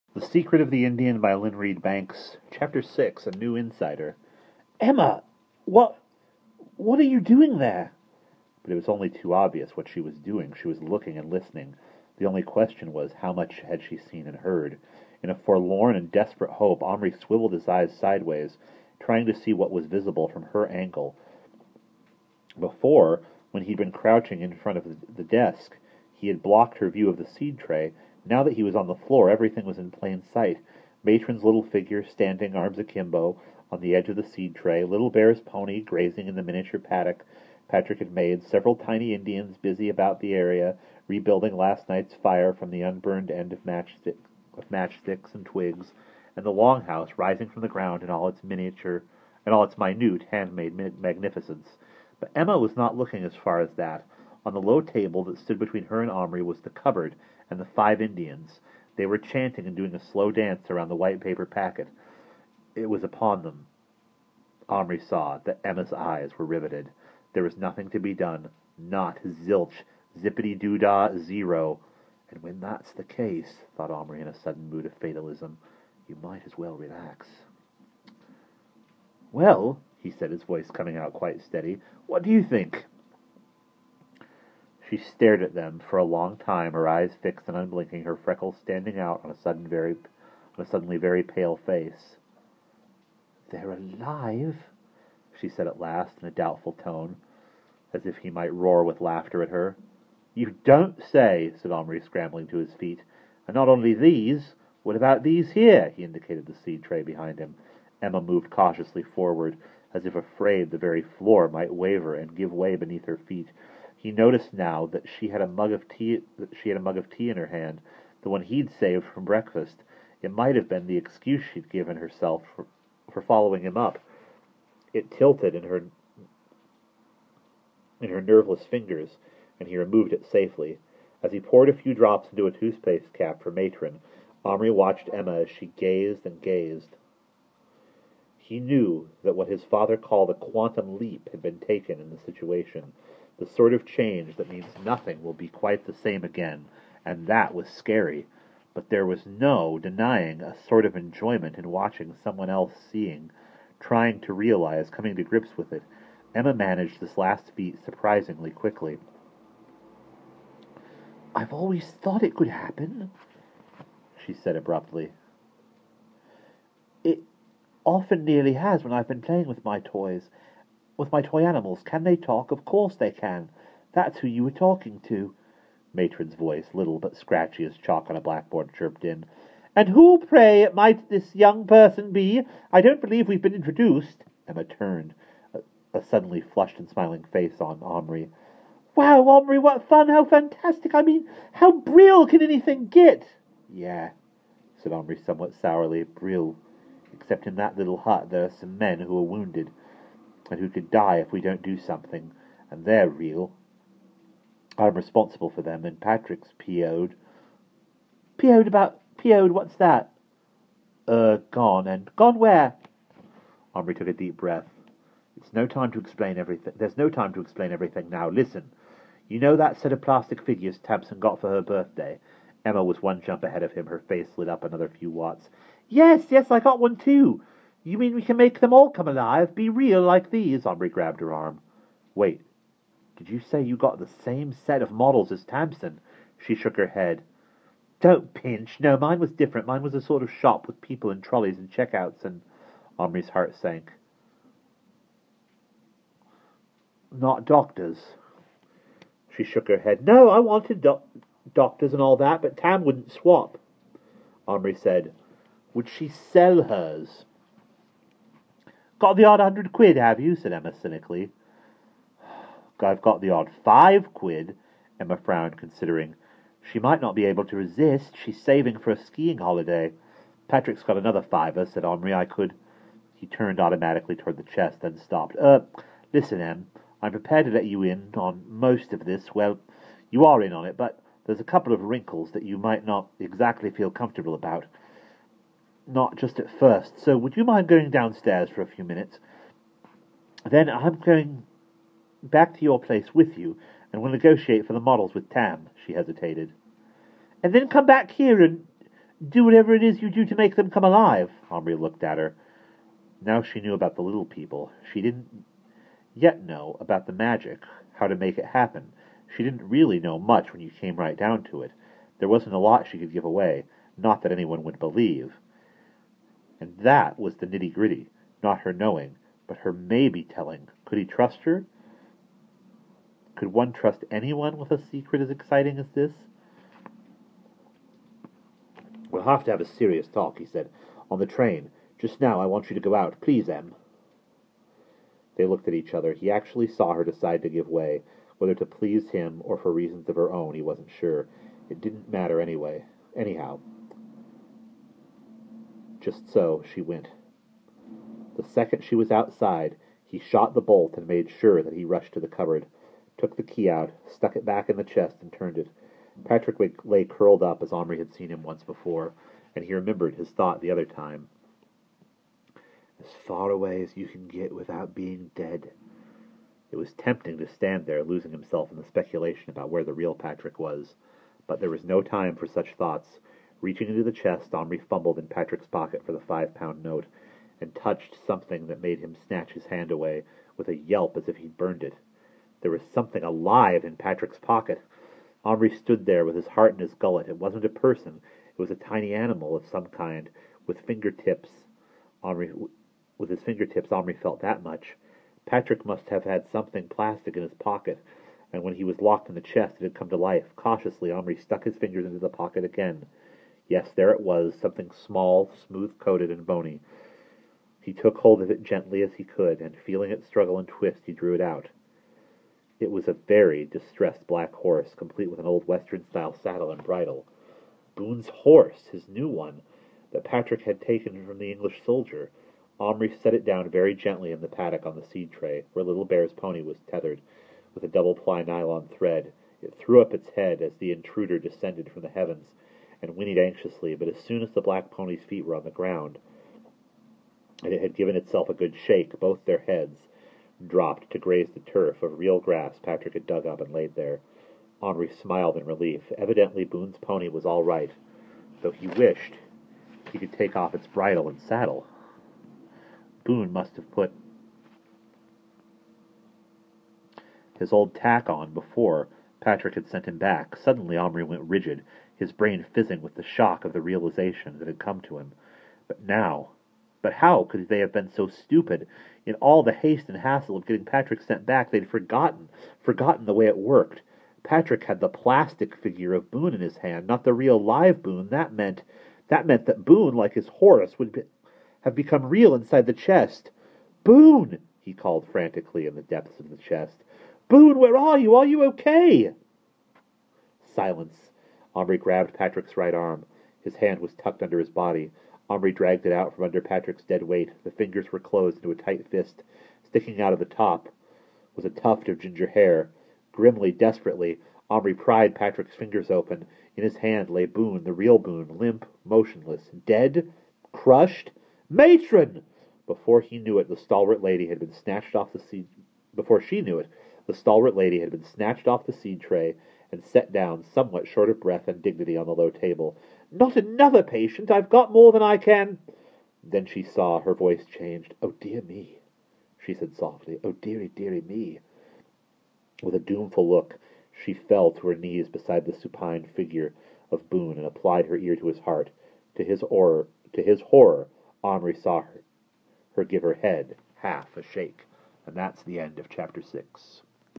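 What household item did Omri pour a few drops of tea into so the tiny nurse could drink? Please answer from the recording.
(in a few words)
Toothpaste cap.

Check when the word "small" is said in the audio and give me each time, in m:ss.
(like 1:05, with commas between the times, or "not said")
6:44.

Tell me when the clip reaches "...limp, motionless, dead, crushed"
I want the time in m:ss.
8:28.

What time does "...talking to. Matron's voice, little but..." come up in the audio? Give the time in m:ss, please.
2:54.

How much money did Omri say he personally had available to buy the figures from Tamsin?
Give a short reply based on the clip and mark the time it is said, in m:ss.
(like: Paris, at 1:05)
5 pounds, at 4:23.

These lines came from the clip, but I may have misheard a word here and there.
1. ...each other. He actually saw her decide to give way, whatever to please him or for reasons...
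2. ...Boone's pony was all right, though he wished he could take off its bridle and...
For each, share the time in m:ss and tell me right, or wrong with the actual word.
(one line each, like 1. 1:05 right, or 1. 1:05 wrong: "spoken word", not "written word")
1. 5:35 wrong: "whether", not "whatever"
2. 7:26 right.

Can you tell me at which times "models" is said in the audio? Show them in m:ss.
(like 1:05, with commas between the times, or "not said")
3:54, 4:54.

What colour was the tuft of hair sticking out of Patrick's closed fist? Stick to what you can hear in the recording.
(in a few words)
Ginger.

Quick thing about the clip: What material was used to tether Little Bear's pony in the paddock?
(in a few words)
Nylon thread.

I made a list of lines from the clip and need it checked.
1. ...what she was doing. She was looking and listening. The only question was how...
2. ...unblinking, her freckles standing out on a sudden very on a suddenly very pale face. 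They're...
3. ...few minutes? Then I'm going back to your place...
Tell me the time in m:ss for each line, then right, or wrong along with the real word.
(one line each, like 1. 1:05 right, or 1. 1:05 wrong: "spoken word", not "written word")
1. 0:09 right
2. 1:27 right
3. 4:48 right.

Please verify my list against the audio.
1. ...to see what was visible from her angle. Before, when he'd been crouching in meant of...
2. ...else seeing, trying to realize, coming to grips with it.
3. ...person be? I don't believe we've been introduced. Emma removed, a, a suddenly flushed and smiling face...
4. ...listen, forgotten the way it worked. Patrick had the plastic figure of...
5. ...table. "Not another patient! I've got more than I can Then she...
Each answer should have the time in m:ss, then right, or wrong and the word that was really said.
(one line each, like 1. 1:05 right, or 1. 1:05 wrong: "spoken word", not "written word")
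1. 0:19 wrong: "front", not "meant"
2. 2:32 right
3. 3:01 wrong: "turned", not "removed"
4. 7:51 wrong: "forgotten", not "listen"
5. 8:42 right.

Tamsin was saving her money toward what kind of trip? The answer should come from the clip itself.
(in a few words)
Skiing holiday.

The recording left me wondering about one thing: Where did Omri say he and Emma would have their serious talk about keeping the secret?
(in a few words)
On the train.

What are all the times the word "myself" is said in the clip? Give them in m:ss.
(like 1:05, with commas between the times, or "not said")
not said.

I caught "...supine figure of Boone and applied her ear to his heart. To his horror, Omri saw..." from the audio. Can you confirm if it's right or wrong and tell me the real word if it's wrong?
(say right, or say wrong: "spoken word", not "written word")
right.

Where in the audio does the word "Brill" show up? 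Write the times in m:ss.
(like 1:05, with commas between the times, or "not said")
3:11, 3:16.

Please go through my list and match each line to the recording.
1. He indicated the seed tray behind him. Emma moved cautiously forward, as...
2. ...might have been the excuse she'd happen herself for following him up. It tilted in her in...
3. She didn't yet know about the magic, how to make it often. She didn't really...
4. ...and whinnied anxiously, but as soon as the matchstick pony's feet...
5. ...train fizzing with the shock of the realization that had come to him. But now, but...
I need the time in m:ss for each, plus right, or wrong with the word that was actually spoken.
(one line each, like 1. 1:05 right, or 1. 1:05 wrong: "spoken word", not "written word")
1. 1:45 right
2. 2:00 wrong: "given", not "happen"
3. 5:04 wrong: "happen", not "often"
4. 7:13 wrong: "black", not "matchstick"
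5. 7:42 wrong: "brain", not "train".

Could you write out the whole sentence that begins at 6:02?
As far away as you can get without being dead.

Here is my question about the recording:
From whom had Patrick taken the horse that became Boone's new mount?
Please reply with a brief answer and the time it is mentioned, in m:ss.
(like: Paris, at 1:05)
English soldier, at 7:01.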